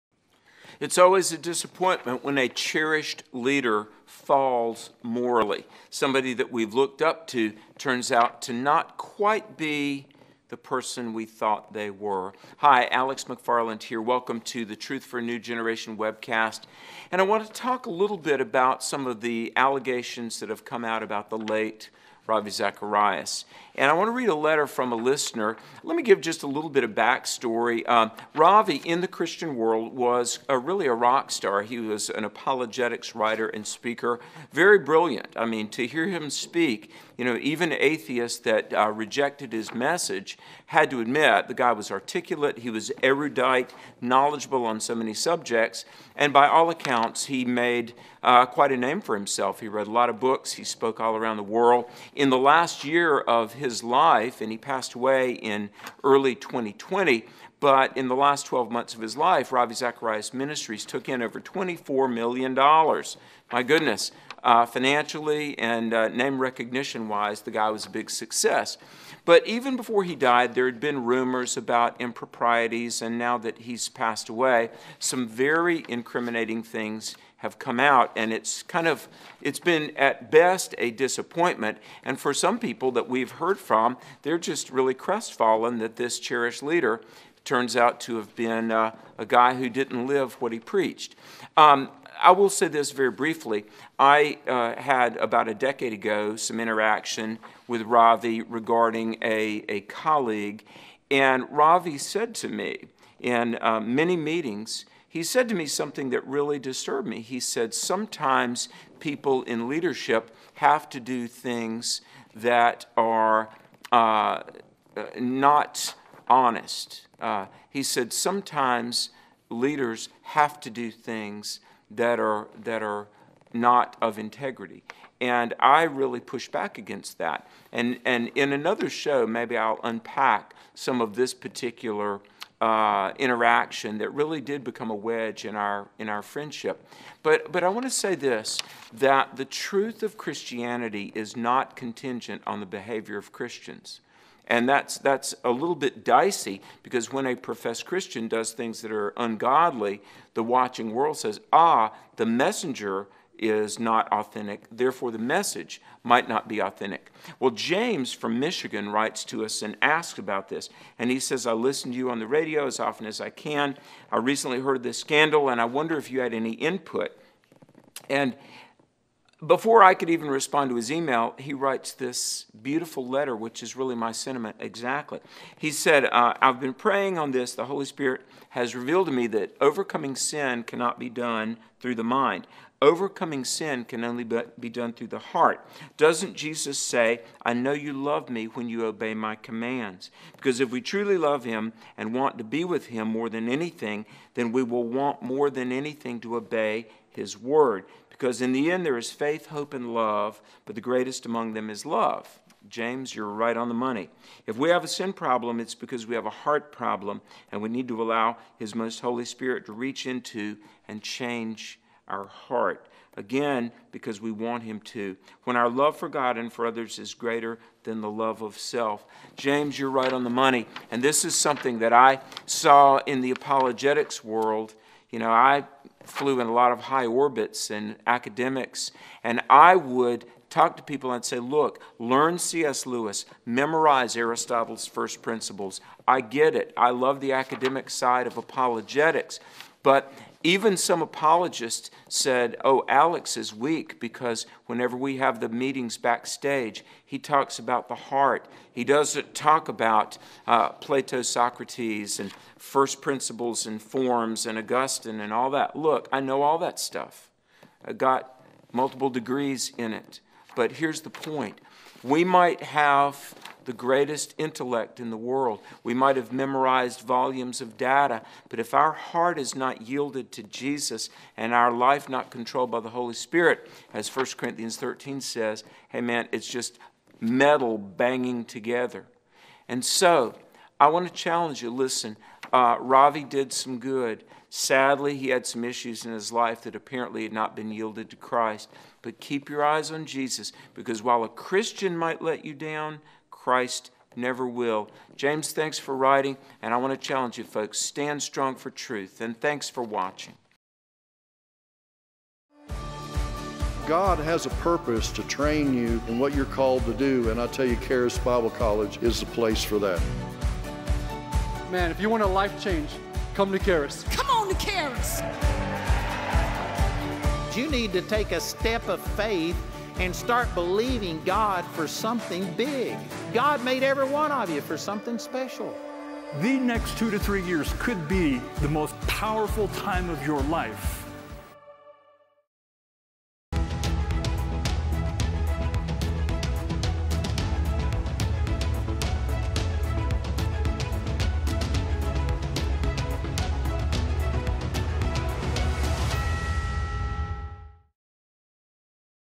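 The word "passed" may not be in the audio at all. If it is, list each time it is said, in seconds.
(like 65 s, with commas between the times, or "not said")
54 s, 73 s.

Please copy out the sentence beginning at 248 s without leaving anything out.
He doesn't talk about uh, Plato, Socrates, and first principles and forms and Augustine and all that.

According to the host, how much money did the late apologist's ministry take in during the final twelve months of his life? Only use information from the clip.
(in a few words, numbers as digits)
$24 million.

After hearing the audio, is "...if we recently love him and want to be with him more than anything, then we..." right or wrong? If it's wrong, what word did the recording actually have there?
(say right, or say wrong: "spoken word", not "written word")
wrong: "truly", not "recently".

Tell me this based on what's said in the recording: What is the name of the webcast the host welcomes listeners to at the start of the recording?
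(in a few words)
Truth for a New Generation.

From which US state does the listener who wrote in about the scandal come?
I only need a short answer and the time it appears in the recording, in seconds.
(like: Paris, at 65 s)
Michigan, at 158 s.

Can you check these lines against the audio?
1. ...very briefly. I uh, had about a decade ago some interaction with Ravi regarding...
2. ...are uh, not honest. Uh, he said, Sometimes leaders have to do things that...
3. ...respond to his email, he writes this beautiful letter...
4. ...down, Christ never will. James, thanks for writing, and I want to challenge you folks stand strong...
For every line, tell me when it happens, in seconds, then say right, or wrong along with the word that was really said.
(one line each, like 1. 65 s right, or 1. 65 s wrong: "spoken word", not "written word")
1. 92 s right
2. 112 s right
3. 170 s right
4. 292 s right.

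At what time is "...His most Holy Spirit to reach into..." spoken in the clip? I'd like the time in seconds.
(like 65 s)
208 s.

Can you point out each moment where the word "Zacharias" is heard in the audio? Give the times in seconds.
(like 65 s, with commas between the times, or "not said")
22 s, 59 s.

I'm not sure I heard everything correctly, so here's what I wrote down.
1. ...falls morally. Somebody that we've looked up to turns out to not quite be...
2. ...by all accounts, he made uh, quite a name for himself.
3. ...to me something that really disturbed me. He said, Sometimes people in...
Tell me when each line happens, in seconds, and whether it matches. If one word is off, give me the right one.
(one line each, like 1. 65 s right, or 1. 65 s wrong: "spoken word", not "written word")
1. 4 s right
2. 46 s right
3. 105 s right.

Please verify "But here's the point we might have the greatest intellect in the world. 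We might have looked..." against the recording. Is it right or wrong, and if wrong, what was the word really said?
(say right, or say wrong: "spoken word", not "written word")
wrong: "memorized", not "looked".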